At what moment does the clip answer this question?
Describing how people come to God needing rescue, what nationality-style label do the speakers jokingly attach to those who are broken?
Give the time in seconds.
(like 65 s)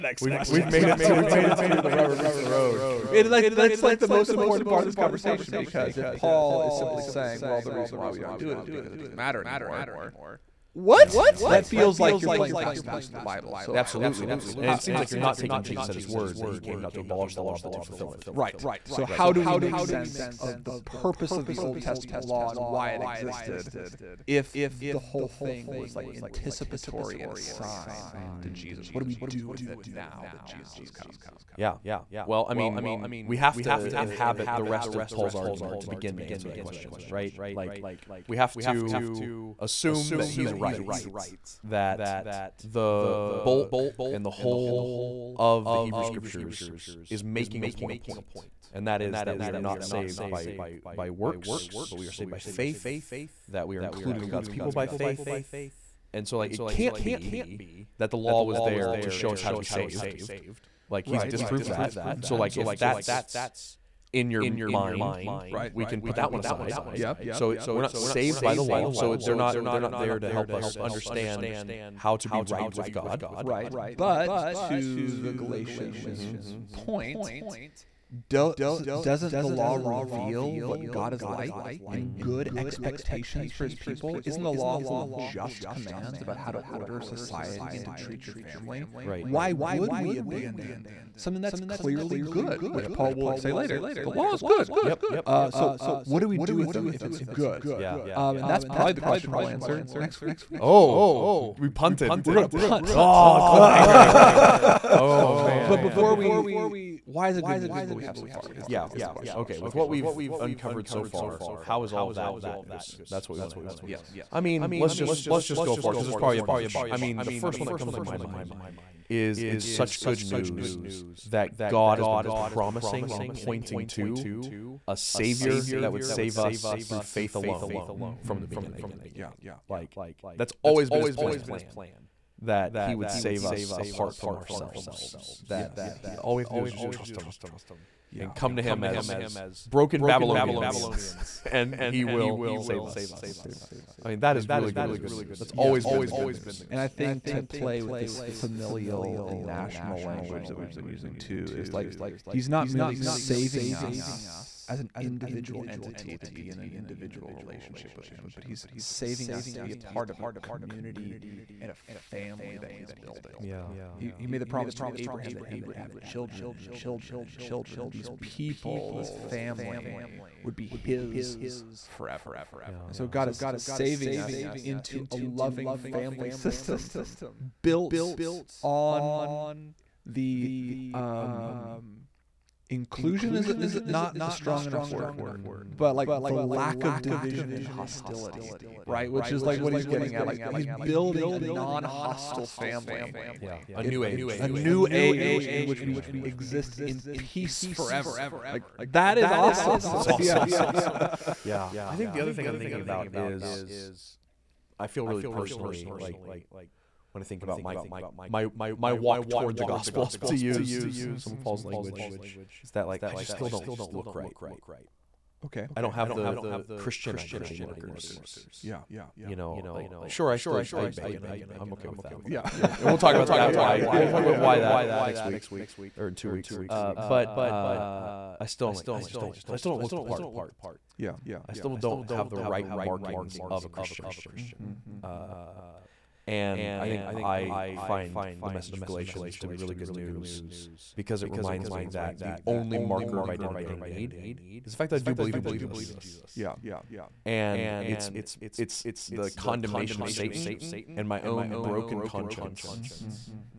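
140 s.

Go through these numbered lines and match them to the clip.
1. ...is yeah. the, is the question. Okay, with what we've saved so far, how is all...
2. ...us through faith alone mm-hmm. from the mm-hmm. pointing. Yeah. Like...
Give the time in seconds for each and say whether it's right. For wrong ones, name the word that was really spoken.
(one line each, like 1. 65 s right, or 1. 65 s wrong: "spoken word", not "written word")
1. 108 s wrong: "uncovered", not "saved"
2. 126 s wrong: "beginning", not "pointing".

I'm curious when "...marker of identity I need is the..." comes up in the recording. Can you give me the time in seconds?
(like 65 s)
242 s.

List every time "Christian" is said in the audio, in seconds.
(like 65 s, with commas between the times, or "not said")
216 s, 233 s.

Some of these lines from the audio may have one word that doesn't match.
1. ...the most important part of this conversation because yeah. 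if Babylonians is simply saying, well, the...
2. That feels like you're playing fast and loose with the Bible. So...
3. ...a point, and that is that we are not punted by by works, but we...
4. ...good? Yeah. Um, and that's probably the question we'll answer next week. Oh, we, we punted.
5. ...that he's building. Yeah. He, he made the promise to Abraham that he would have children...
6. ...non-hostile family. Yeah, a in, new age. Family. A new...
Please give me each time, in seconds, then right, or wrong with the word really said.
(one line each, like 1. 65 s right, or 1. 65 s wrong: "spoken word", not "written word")
1. 3 s wrong: "Paul", not "Babylonians"
2. 11 s right
3. 47 s wrong: "saved", not "punted"
4. 97 s right
5. 162 s right
6. 191 s right.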